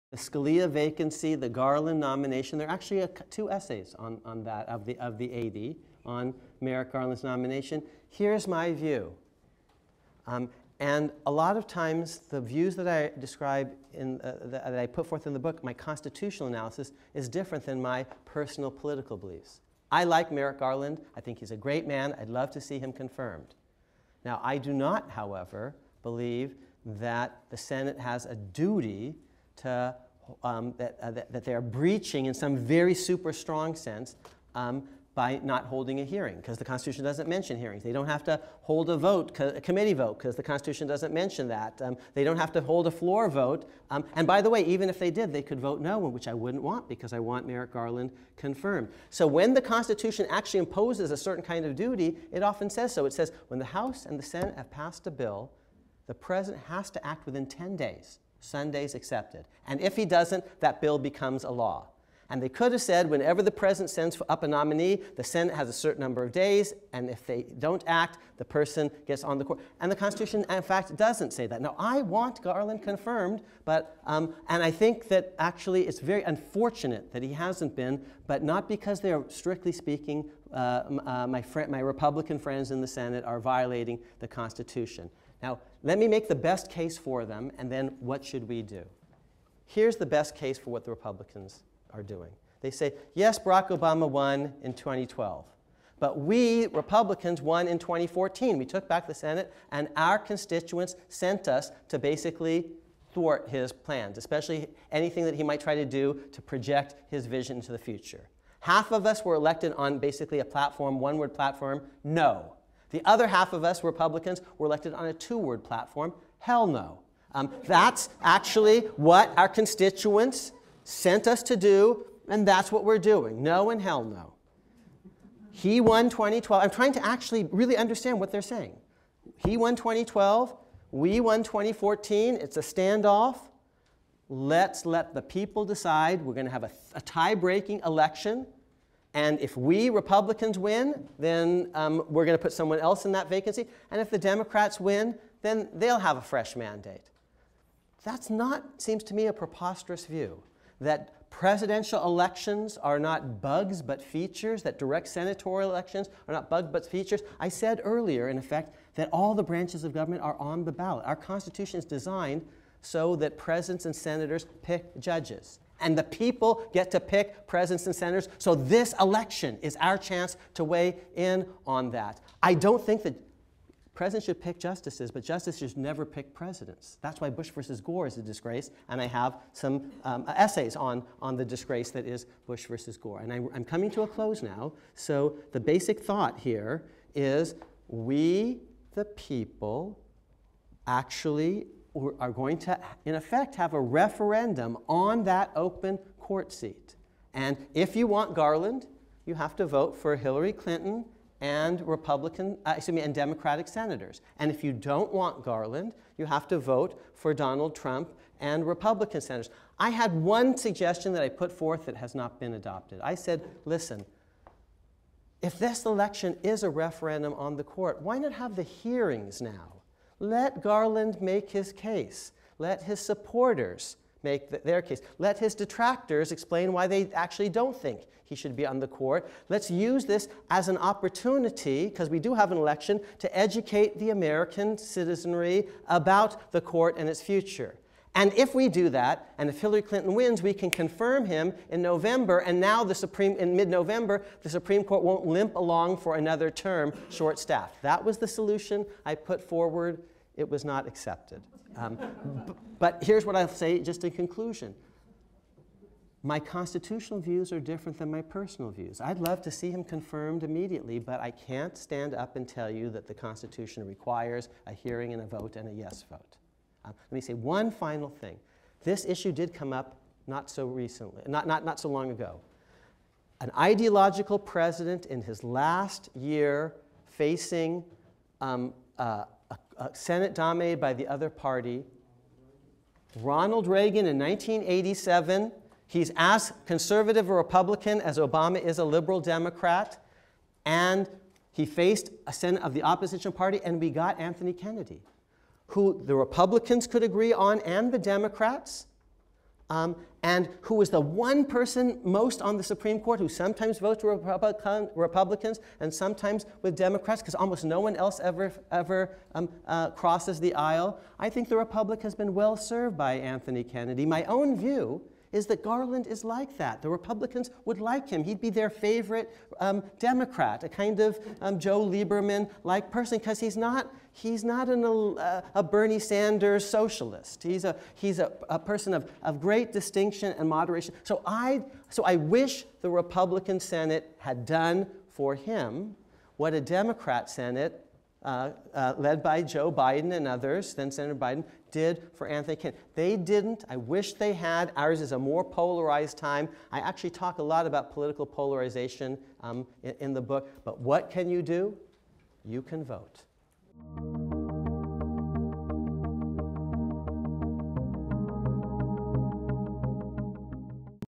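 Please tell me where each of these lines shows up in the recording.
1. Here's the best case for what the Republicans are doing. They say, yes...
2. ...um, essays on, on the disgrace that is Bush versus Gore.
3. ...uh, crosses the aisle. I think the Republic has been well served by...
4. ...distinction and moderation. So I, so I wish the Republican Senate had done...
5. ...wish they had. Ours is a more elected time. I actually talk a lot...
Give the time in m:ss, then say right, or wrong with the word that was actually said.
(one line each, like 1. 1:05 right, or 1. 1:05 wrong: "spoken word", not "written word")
1. 1:29 right
2. 3:00 right
3. 5:09 right
4. 5:29 right
5. 5:43 wrong: "polarized", not "elected".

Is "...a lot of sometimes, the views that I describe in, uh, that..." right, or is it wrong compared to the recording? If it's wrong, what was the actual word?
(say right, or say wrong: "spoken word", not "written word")
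wrong: "times", not "sometimes".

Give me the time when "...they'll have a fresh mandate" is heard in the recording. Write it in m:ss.
2:25.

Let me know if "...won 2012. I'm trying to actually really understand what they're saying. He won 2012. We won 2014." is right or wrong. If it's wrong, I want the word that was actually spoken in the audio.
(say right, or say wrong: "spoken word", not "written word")
right.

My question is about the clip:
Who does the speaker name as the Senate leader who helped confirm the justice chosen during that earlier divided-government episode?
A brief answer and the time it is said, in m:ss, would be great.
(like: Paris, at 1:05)
Joe Biden, at 5:39.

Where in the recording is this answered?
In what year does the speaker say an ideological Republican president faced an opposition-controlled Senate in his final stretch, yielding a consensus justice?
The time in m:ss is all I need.
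4:44.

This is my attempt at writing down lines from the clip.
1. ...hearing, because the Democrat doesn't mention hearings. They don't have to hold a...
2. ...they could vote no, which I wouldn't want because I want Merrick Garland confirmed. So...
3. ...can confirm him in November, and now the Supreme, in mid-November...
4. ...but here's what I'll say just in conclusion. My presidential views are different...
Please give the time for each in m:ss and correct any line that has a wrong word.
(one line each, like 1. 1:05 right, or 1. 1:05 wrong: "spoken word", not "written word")
1. 0:36 wrong: "Constitution", not "Democrat"
2. 0:45 right
3. 4:00 right
4. 4:12 wrong: "constitutional", not "presidential".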